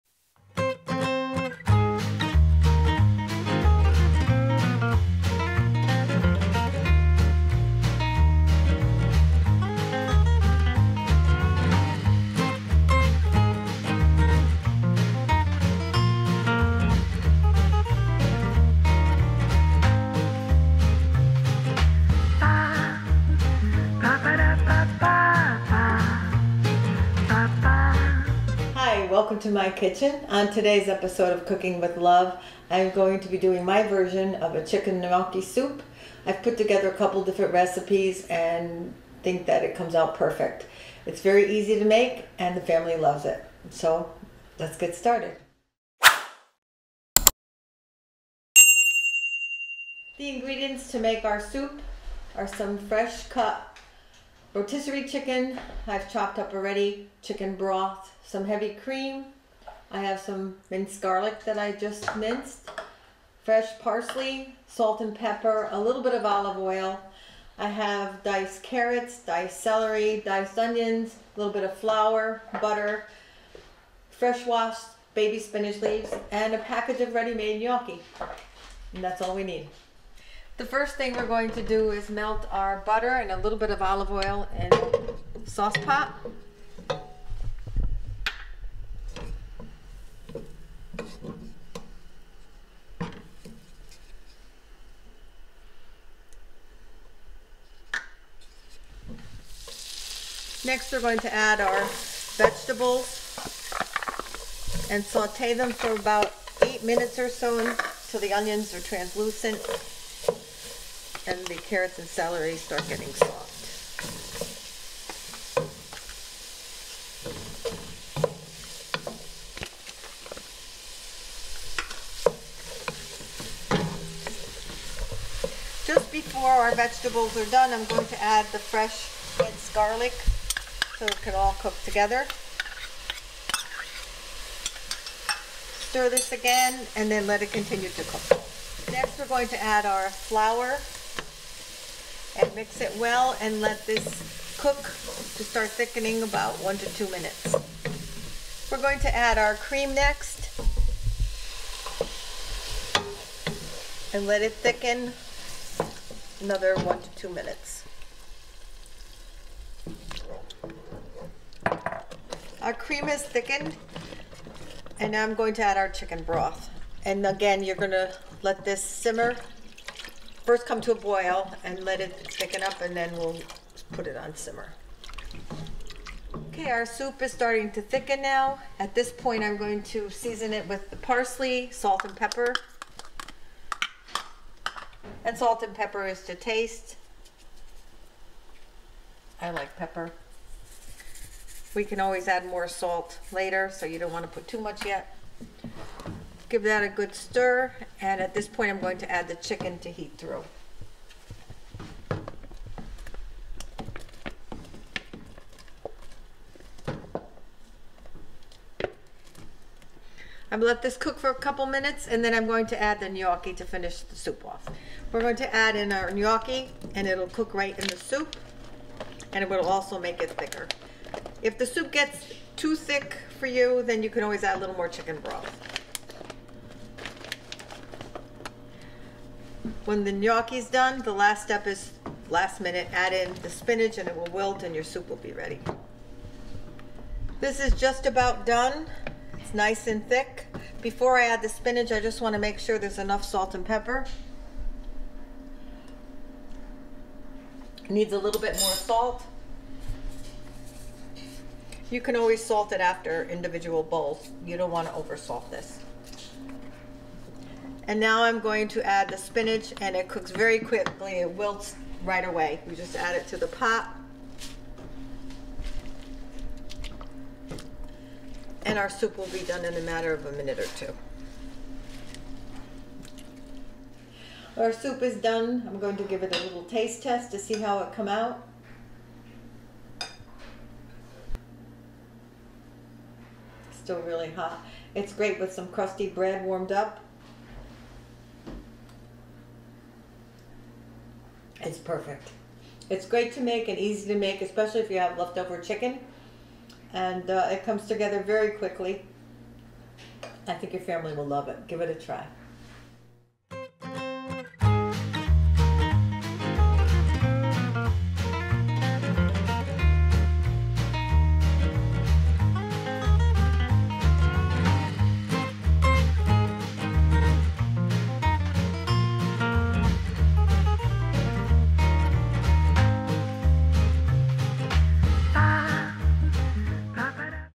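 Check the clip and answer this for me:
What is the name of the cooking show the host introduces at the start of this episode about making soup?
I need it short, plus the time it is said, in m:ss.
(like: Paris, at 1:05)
Cooking with Love, at 0:31.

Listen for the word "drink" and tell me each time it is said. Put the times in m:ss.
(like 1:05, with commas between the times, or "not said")
not said.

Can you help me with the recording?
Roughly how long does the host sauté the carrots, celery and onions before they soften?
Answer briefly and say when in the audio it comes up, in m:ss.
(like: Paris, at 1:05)
8 minutes, at 1:46.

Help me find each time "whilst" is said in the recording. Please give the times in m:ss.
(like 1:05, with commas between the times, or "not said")
not said.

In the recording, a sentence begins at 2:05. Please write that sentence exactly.
Just before our vegetables are done, I'm going to add the fresh minced garlic so it can all cook together.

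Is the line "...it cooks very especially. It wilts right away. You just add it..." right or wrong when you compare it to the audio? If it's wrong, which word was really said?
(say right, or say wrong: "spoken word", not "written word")
wrong: "quickly", not "especially".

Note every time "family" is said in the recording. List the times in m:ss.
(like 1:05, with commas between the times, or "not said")
0:42, 5:00.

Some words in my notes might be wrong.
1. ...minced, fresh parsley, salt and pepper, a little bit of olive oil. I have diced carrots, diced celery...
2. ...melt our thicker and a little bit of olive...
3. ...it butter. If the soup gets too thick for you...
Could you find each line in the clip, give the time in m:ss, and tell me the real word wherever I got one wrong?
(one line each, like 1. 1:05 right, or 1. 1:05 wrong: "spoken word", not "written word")
1. 1:02 right
2. 1:22 wrong: "butter", not "thicker"
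3. 3:40 wrong: "thicker", not "butter".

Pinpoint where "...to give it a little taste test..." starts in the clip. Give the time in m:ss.
4:35.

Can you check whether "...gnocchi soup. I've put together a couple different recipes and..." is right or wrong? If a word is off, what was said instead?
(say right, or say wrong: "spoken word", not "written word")
right.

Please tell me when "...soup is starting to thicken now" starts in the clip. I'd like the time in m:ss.
2:56.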